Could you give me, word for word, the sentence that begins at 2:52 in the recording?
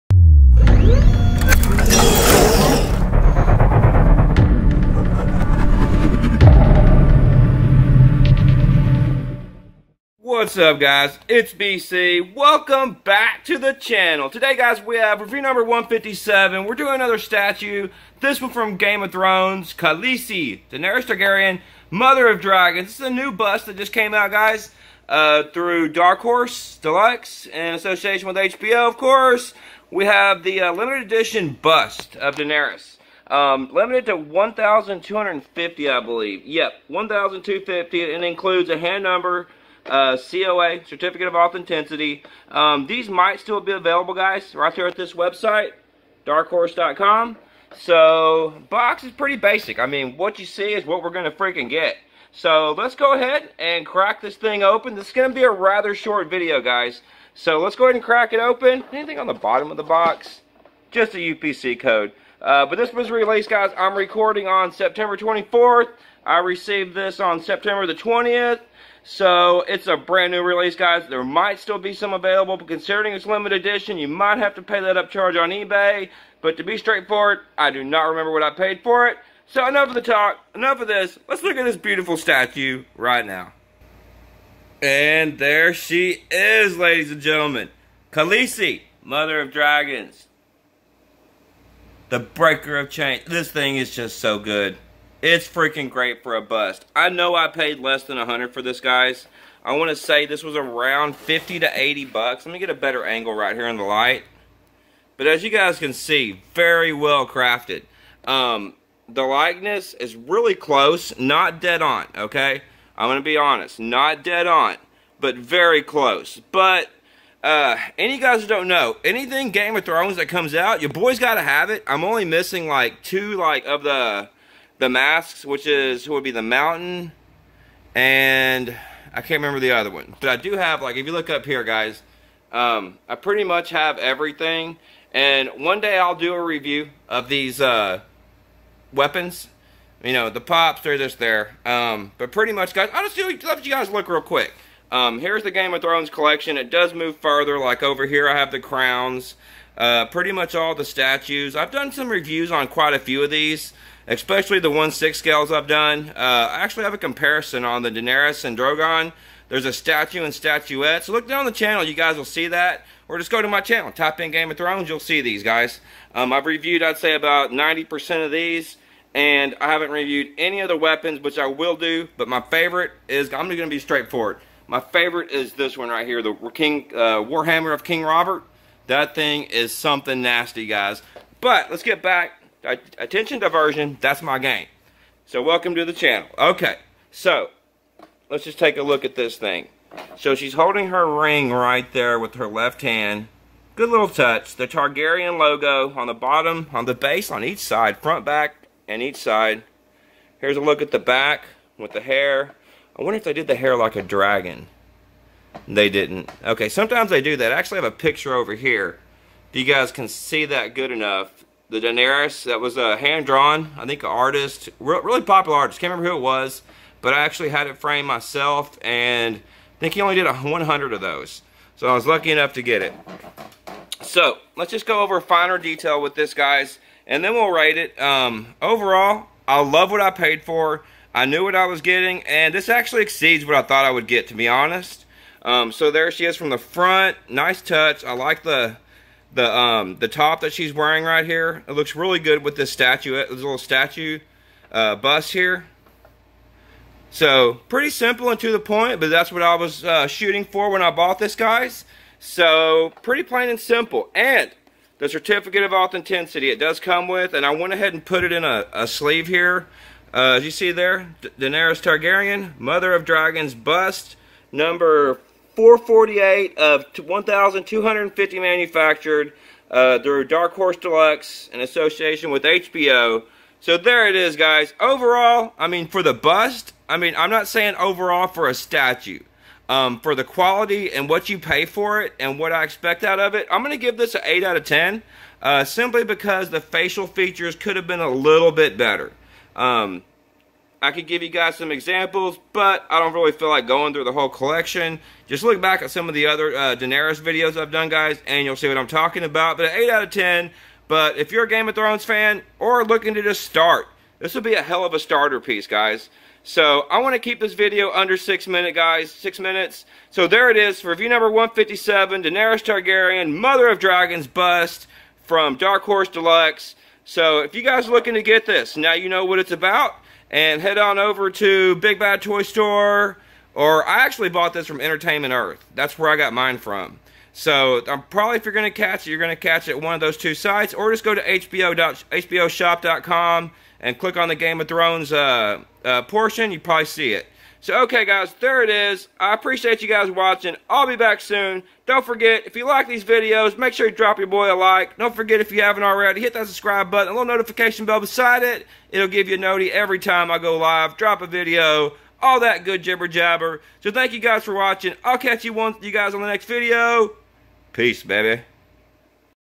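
But my favorite is, I'm going to be straightforward.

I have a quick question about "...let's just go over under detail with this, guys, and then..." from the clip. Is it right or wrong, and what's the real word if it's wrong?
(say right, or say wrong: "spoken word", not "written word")
wrong: "finer", not "under".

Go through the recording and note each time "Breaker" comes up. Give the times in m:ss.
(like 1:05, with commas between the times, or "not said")
1:32.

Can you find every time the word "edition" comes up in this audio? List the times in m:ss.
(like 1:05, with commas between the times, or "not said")
0:31, 1:13.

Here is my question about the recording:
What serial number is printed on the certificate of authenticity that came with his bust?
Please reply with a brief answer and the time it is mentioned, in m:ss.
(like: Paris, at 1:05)
448, at 4:25.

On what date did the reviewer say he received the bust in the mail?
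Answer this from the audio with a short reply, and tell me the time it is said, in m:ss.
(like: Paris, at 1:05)
September 20, at 1:07.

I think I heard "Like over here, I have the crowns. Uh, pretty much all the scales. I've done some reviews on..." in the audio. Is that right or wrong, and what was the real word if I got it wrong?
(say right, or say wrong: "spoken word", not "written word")
wrong: "statues", not "scales".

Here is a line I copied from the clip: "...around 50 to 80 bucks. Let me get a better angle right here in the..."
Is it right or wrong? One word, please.
right.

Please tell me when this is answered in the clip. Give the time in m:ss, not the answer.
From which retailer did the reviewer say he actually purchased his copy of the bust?
5:24.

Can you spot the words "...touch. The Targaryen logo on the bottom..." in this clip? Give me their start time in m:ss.
3:14.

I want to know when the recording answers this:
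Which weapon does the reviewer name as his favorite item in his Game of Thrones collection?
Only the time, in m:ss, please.
2:57.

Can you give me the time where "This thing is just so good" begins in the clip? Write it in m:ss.
1:33.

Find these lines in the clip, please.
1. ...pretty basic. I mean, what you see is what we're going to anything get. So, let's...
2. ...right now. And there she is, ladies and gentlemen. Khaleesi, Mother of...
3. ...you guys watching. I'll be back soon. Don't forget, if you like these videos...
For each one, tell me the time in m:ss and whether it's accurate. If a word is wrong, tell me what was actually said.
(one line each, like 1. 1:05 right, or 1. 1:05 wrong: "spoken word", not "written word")
1. 0:49 wrong: "freaking", not "anything"
2. 1:22 right
3. 5:39 right.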